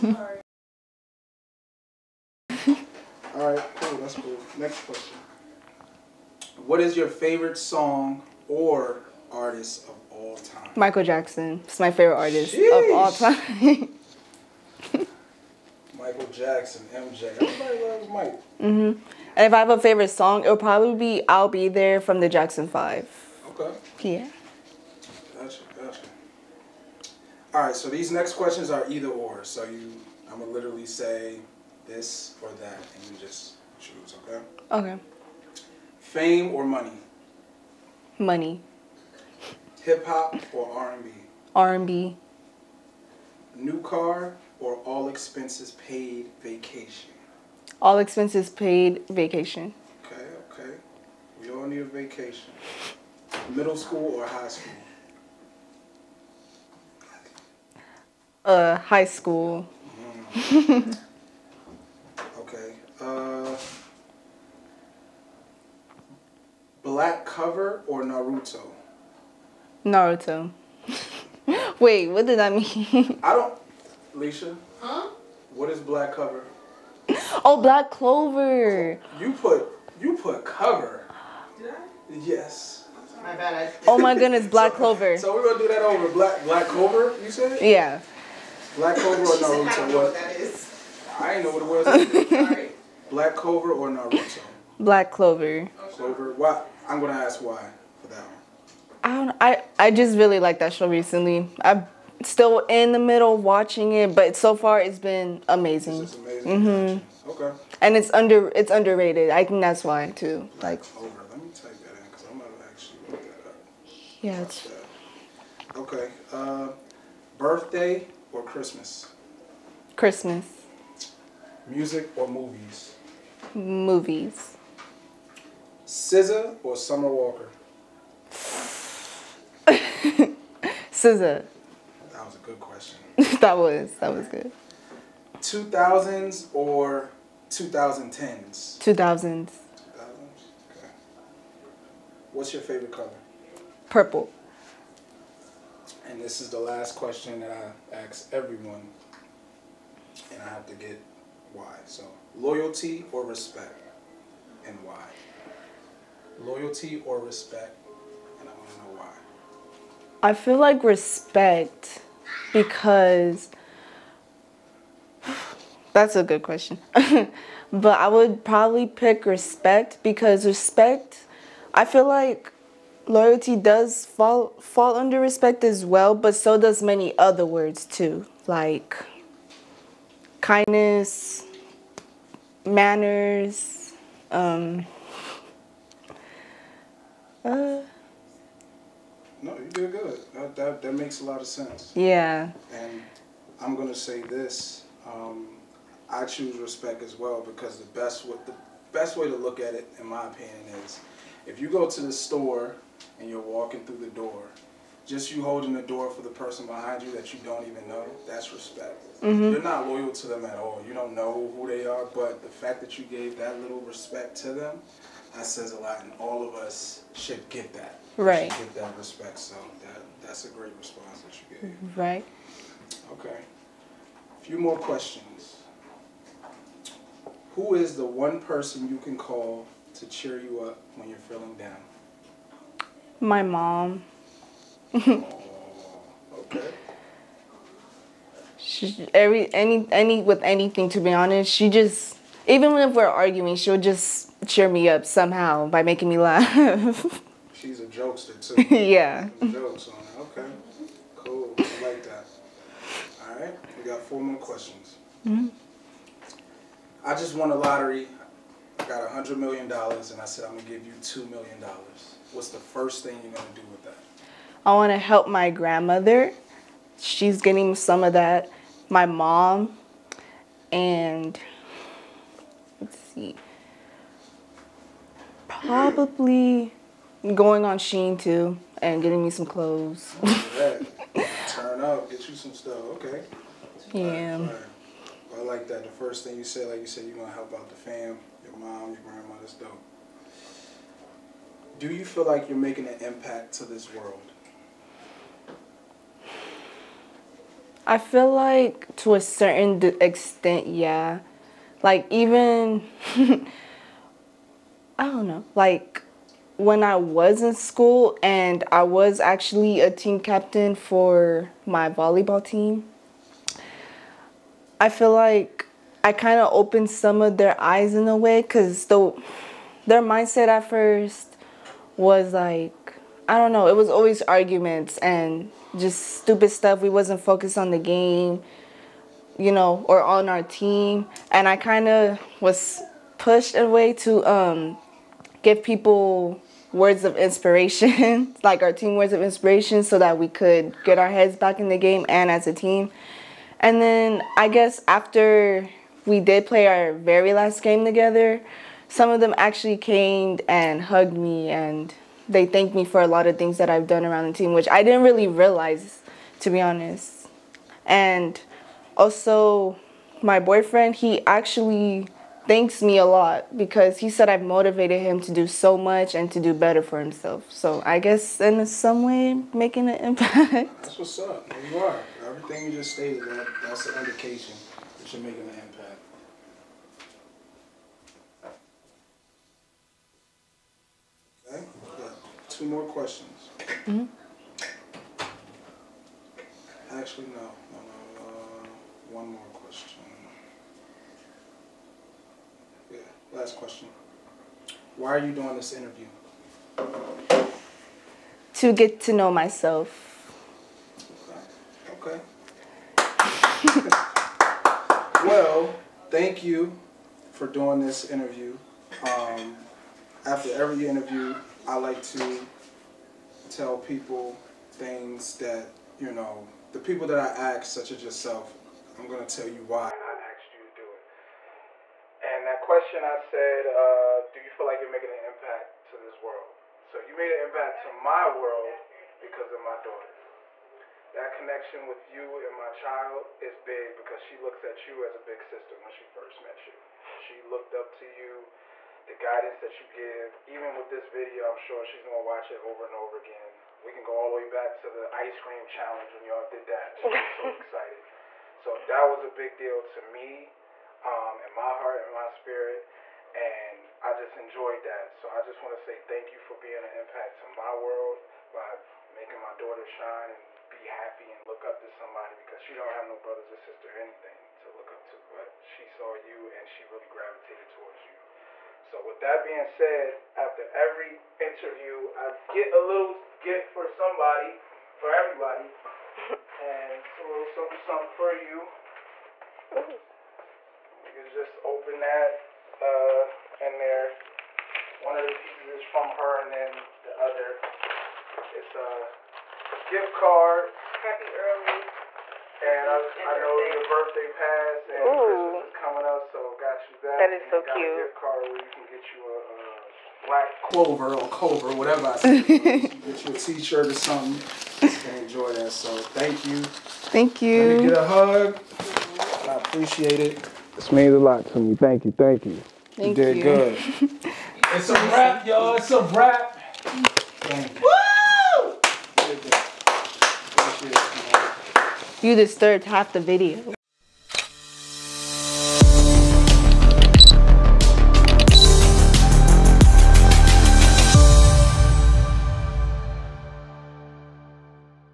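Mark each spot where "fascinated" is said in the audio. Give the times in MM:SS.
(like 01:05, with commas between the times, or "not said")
not said.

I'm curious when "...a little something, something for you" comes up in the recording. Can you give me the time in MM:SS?
07:57.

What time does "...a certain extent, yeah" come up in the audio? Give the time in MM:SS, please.
04:59.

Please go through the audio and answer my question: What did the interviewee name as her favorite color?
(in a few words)
Purple.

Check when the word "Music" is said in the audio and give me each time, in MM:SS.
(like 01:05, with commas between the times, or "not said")
02:01.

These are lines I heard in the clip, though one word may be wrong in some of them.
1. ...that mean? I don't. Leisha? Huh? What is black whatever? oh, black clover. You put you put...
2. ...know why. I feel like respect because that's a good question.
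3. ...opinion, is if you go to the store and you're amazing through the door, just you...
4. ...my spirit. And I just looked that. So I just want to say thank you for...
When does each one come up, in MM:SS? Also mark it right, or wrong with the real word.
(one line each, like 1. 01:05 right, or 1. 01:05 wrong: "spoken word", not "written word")
1. 01:12 wrong: "cover", not "whatever"
2. 02:38 right
3. 03:20 wrong: "walking", not "amazing"
4. 07:32 wrong: "enjoyed", not "looked".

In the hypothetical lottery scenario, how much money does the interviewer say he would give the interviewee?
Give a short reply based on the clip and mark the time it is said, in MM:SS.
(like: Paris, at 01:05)
2 million dollars, at 04:21.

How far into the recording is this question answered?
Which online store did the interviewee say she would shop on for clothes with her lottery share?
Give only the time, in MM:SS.
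04:37.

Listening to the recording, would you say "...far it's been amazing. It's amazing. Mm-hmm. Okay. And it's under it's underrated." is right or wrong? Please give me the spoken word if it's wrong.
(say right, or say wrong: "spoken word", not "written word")
right.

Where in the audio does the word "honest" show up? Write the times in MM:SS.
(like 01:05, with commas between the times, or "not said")
04:01, 05:56.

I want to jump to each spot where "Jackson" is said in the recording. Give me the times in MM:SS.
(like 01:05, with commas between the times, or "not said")
00:11, 00:16, 00:22.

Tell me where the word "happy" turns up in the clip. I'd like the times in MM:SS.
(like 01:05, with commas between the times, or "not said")
07:40, 08:11.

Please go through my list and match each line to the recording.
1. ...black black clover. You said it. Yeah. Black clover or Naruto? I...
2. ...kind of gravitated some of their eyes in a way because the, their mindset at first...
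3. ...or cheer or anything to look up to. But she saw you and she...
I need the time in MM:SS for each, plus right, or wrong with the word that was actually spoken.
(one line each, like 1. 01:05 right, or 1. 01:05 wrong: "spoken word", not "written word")
1. 01:26 right
2. 05:16 wrong: "opened", not "gravitated"
3. 07:43 wrong: "sister", not "cheer".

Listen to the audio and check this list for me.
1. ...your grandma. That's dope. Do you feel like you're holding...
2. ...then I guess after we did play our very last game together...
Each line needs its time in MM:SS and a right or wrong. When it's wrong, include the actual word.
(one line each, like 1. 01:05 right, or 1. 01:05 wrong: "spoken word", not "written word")
1. 04:48 wrong: "making", not "holding"
2. 05:43 right.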